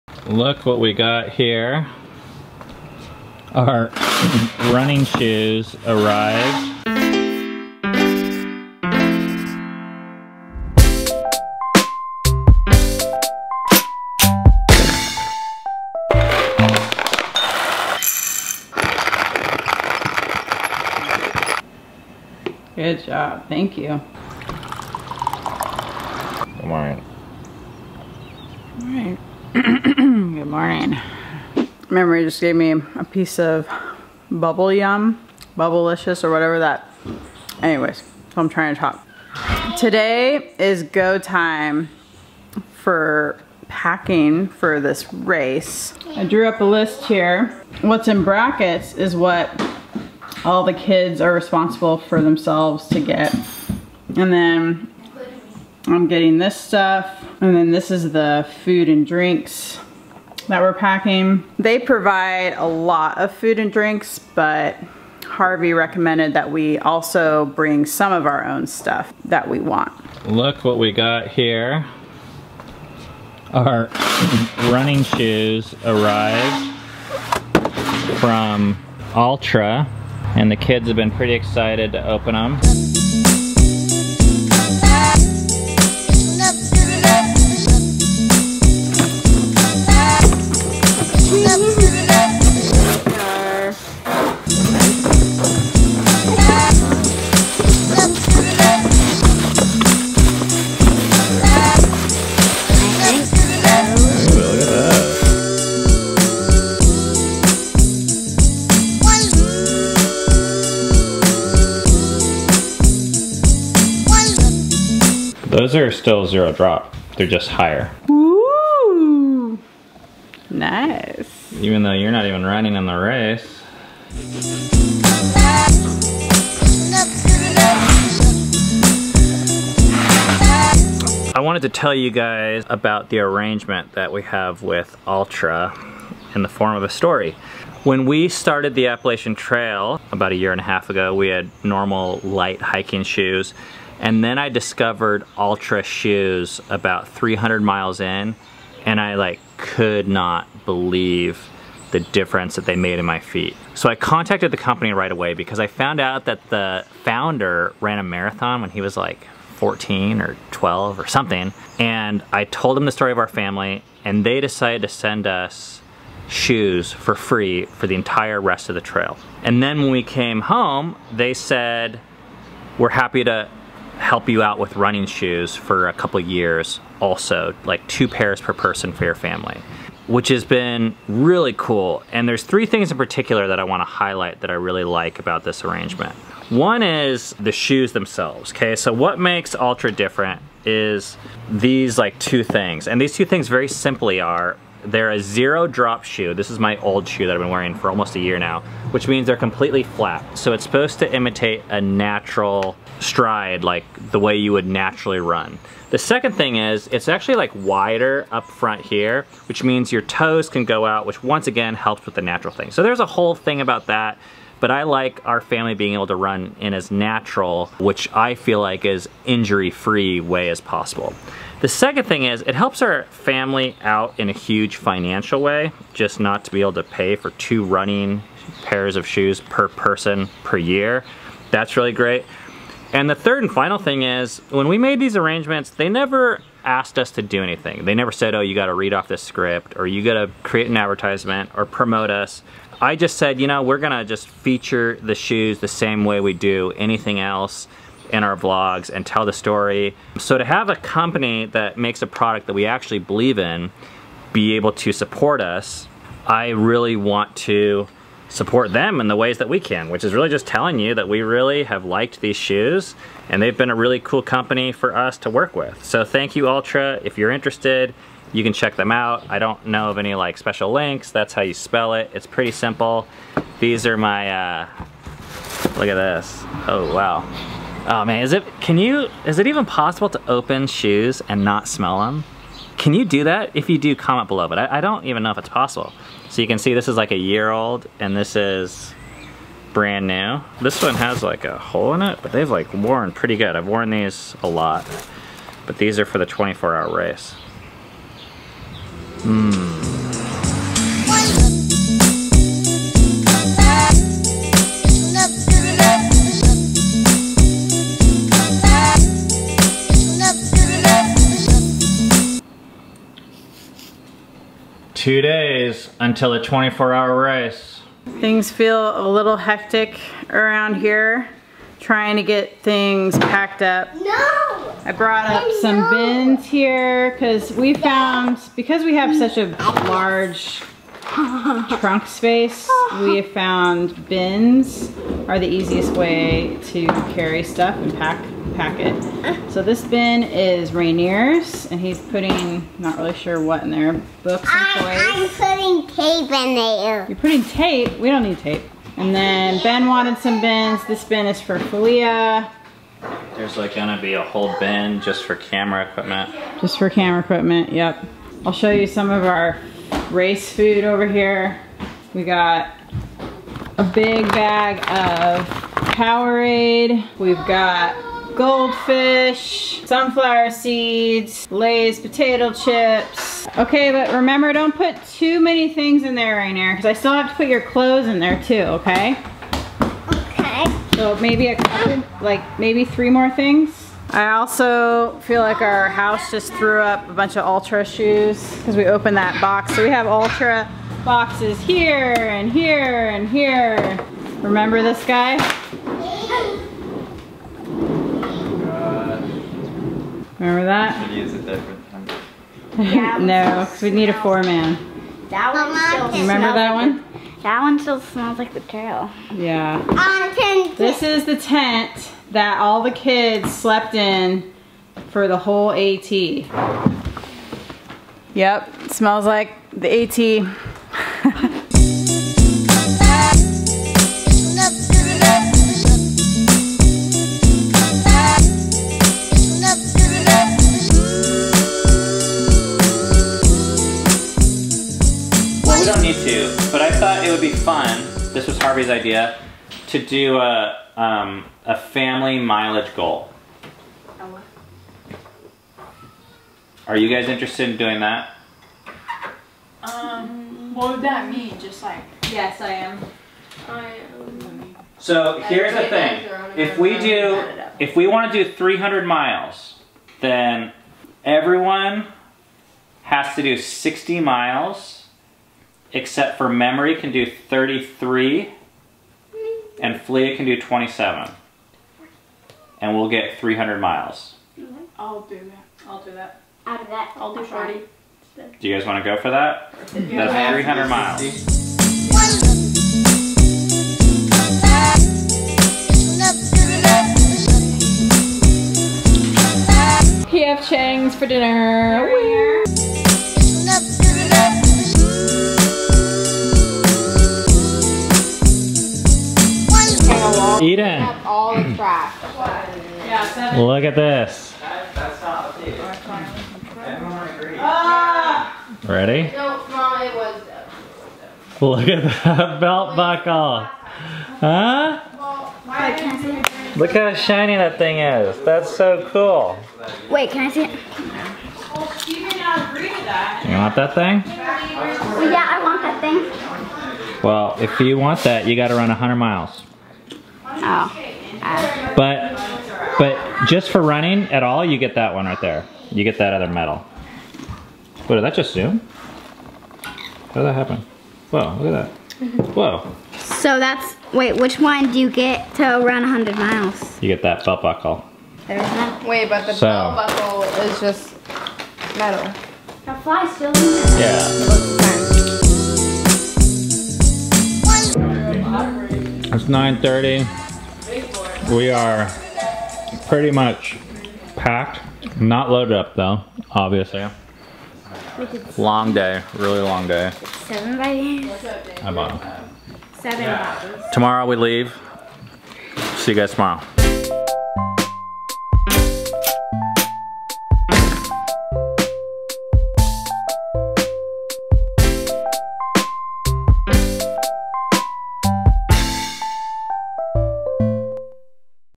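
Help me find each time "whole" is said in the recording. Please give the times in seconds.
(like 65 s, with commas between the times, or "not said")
213 s, 354 s, 415 s.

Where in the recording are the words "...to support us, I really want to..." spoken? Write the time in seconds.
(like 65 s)
254 s.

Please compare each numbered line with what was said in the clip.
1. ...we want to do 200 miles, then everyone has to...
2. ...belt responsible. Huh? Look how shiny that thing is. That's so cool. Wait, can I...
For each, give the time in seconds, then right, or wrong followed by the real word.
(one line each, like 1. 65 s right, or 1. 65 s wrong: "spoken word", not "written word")
1. 457 s wrong: "300", not "200"
2. 512 s wrong: "buckle", not "responsible".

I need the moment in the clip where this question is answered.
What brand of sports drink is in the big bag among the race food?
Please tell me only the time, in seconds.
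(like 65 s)
365 s.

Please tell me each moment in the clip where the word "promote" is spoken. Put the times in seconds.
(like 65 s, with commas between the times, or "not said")
241 s.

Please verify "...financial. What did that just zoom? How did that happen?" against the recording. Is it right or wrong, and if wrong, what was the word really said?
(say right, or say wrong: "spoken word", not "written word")
wrong: "medal", not "financial".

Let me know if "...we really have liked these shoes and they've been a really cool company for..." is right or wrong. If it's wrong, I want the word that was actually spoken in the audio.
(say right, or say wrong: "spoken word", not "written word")
right.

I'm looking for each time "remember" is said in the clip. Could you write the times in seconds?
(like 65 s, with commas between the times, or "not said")
374 s, 394 s, 400 s, 406 s.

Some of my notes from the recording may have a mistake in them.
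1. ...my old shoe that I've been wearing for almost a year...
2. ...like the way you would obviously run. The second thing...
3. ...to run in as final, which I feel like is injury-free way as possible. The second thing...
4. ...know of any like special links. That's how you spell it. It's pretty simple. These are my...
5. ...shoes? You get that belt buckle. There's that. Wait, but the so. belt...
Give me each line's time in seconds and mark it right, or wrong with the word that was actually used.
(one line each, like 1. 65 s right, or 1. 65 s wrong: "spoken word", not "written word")
1. 196 s right
2. 203 s wrong: "naturally", not "obviously"
3. 216 s wrong: "natural", not "final"
4. 269 s right
5. 546 s wrong: "miles", not "shoes".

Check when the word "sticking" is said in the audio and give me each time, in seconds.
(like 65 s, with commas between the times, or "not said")
not said.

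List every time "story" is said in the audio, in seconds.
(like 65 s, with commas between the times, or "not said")
136 s, 162 s, 249 s.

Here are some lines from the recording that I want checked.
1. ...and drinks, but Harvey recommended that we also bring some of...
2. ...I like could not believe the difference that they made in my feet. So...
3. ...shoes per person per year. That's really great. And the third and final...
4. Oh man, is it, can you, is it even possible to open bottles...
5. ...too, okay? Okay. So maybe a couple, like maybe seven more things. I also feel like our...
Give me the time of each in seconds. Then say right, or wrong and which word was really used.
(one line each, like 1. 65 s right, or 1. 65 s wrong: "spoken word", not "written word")
1. 63 s right
2. 148 s right
3. 229 s right
4. 277 s wrong: "shoes", not "bottles"
5. 378 s wrong: "three", not "seven".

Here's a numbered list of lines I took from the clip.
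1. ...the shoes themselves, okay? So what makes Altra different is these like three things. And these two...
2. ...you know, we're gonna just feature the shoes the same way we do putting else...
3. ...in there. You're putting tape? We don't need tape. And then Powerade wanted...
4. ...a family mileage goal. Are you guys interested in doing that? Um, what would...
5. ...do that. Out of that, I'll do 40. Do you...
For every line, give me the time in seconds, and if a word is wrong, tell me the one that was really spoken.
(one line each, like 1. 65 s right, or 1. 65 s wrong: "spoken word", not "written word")
1. 187 s wrong: "two", not "three"
2. 243 s wrong: "anything", not "putting"
3. 346 s wrong: "Ben", not "Powerade"
4. 441 s right
5. 476 s right.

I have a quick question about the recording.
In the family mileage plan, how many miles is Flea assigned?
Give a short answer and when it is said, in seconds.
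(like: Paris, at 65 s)
27, at 470 s.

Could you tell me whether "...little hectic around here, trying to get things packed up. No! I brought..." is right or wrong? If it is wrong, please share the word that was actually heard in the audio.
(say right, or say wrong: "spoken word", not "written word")
right.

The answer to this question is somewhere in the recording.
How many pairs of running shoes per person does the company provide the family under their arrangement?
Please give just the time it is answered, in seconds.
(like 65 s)
177 s.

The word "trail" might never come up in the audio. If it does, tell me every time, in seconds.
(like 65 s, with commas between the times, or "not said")
139 s, 168 s, 408 s.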